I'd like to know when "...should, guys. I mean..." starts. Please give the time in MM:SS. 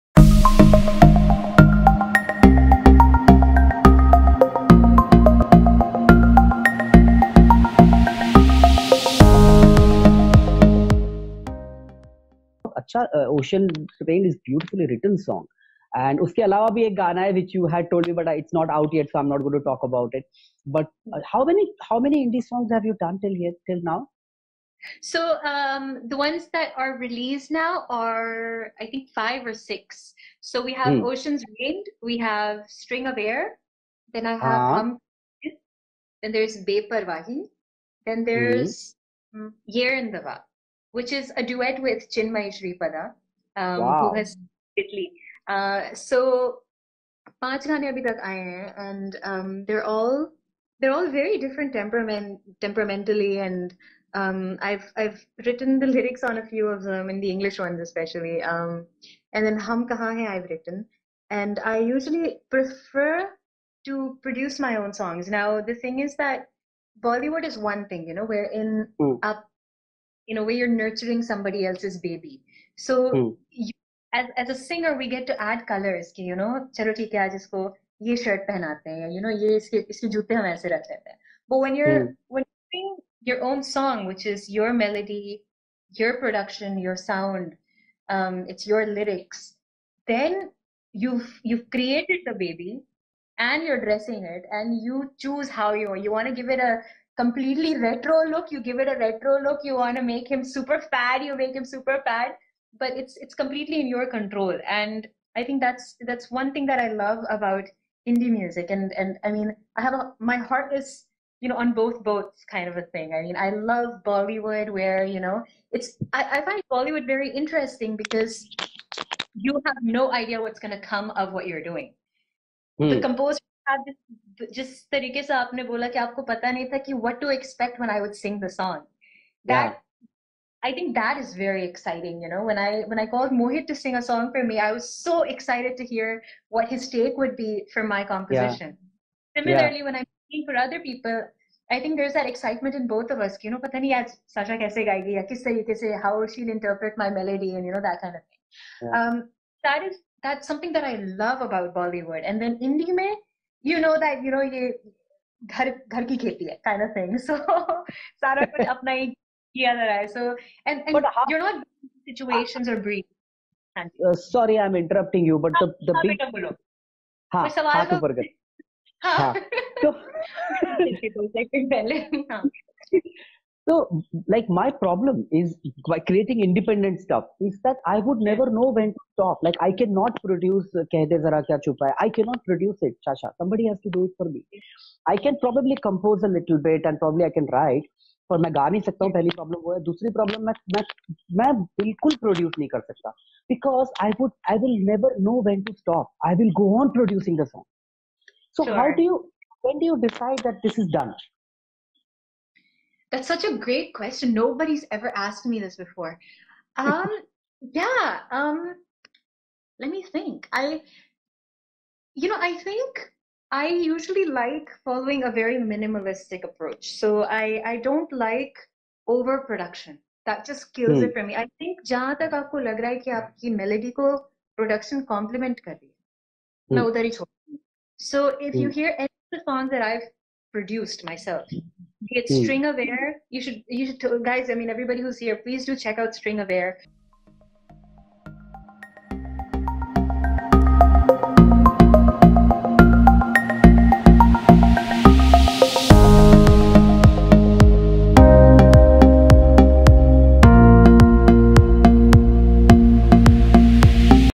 03:53.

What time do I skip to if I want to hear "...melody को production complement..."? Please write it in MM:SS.
03:43.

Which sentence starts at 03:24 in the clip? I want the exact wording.
Nobody's ever asked me this before.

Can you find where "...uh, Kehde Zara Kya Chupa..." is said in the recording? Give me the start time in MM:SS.
03:00.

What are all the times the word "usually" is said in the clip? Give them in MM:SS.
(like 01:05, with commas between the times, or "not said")
01:01, 03:33.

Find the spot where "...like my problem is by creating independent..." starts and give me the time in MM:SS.
02:54.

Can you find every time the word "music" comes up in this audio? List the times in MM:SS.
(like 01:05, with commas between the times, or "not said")
01:48.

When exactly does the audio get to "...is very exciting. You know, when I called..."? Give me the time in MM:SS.
02:11.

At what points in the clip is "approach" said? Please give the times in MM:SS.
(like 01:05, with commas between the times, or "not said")
03:36.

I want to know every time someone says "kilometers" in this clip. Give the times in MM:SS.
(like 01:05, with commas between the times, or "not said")
not said.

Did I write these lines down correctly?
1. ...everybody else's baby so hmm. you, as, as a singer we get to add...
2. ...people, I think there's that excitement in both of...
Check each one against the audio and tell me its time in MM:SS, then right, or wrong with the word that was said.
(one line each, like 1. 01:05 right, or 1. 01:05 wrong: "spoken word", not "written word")
1. 01:11 wrong: "somebody", not "everybody"
2. 02:20 right.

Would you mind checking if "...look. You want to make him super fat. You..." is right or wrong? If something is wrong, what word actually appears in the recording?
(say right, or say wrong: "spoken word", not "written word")
right.